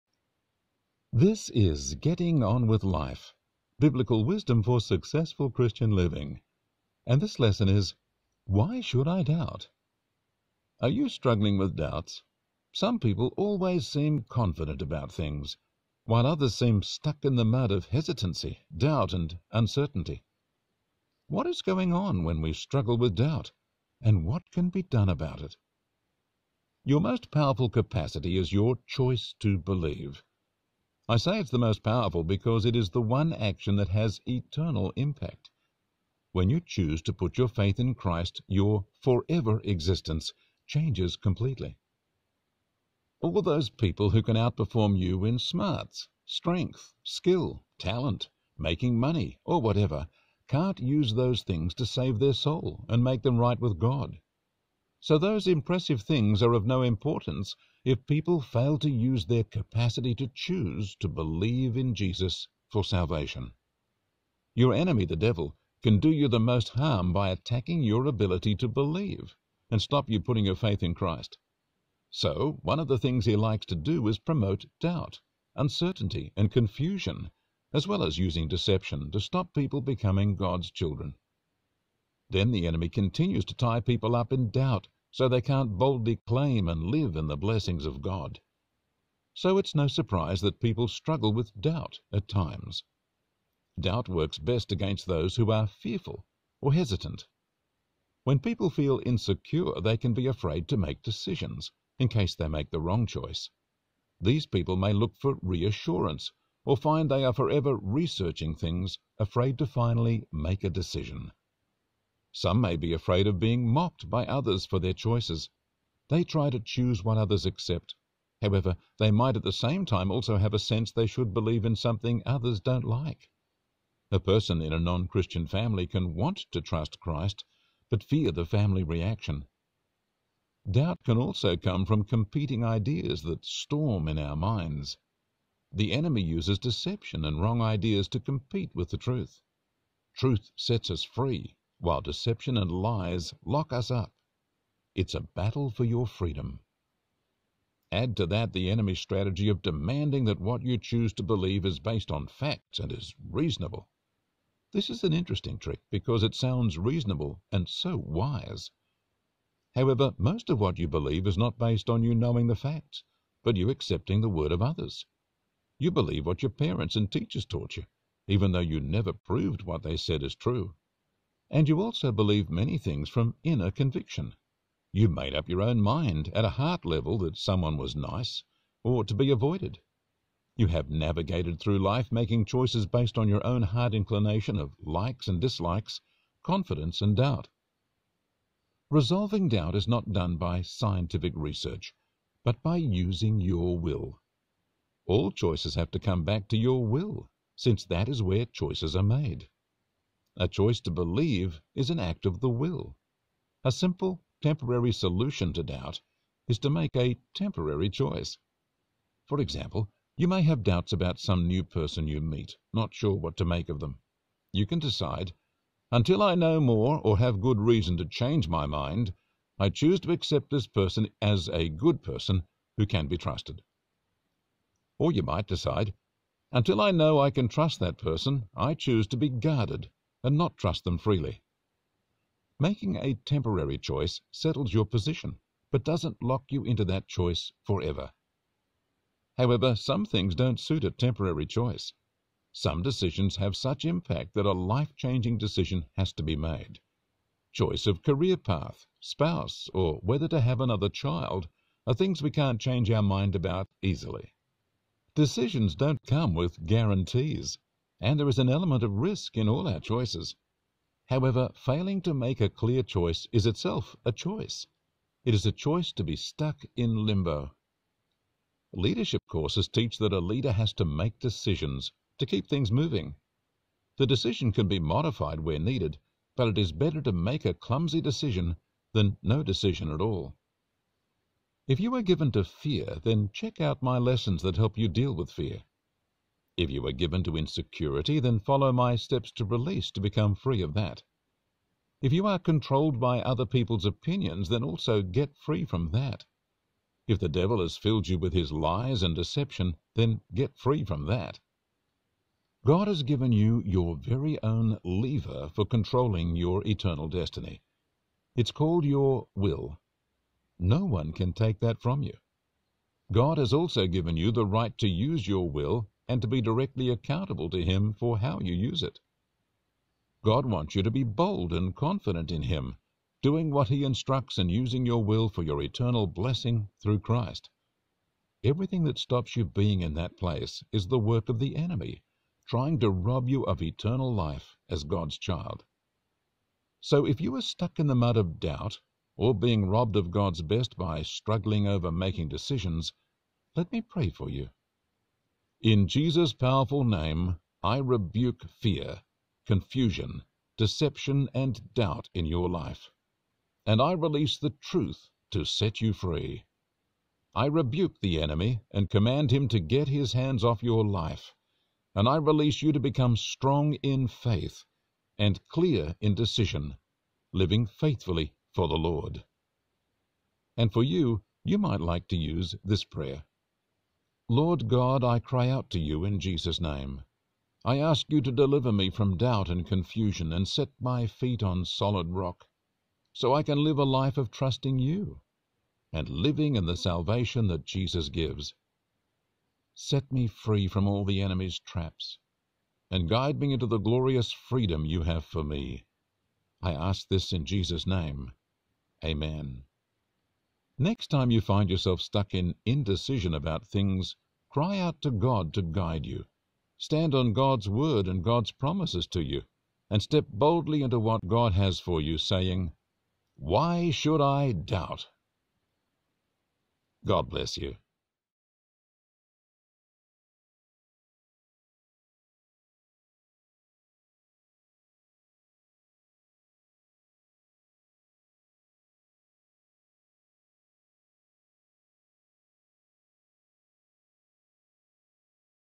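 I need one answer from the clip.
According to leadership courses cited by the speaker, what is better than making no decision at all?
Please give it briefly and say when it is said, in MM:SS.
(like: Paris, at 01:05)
A clumsy decision, at 04:37.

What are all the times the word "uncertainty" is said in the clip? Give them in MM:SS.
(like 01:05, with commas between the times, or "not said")
00:19, 01:15.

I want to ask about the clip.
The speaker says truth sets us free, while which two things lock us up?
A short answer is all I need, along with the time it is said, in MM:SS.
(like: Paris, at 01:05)
Deception and lies, at 02:21.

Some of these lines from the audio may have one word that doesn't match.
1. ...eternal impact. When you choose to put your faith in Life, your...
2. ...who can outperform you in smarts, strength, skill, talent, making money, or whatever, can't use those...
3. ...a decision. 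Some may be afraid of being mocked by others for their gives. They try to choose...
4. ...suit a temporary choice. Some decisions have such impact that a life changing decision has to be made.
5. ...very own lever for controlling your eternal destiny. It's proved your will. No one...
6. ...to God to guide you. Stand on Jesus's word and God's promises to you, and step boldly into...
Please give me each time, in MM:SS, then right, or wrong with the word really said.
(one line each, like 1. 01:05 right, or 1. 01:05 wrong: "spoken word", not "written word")
1. 00:34 wrong: "Christ", not "Life"
2. 00:44 right
3. 01:50 wrong: "choices", not "gives"
4. 04:00 right
5. 05:03 wrong: "called", not "proved"
6. 06:45 wrong: "God", not "Jesus".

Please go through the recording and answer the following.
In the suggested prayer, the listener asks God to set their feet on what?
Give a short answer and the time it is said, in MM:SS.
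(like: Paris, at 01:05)
Solid rock, at 06:21.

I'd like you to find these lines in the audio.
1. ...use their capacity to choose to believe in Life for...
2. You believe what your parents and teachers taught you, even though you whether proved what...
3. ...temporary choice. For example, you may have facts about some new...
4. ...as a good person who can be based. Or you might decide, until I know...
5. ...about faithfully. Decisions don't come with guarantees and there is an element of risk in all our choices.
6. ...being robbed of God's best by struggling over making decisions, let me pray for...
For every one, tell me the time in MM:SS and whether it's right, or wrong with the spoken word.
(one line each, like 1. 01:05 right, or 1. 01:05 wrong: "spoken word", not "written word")
1. 00:58 wrong: "Jesus", not "Life"
2. 02:45 wrong: "never", not "whether"
3. 03:27 wrong: "doubts", not "facts"
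4. 03:41 wrong: "trusted", not "based"
5. 04:13 wrong: "easily", not "faithfully"
6. 05:39 right.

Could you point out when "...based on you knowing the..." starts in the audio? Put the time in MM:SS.
02:41.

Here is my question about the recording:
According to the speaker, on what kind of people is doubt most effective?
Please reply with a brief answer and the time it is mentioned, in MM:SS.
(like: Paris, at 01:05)
Fearful or hesitant, at 01:35.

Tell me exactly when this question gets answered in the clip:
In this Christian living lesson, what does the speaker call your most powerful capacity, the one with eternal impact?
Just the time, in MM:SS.
00:28.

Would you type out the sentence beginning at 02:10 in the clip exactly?
Doubt can also come from competing ideas that storm in our minds.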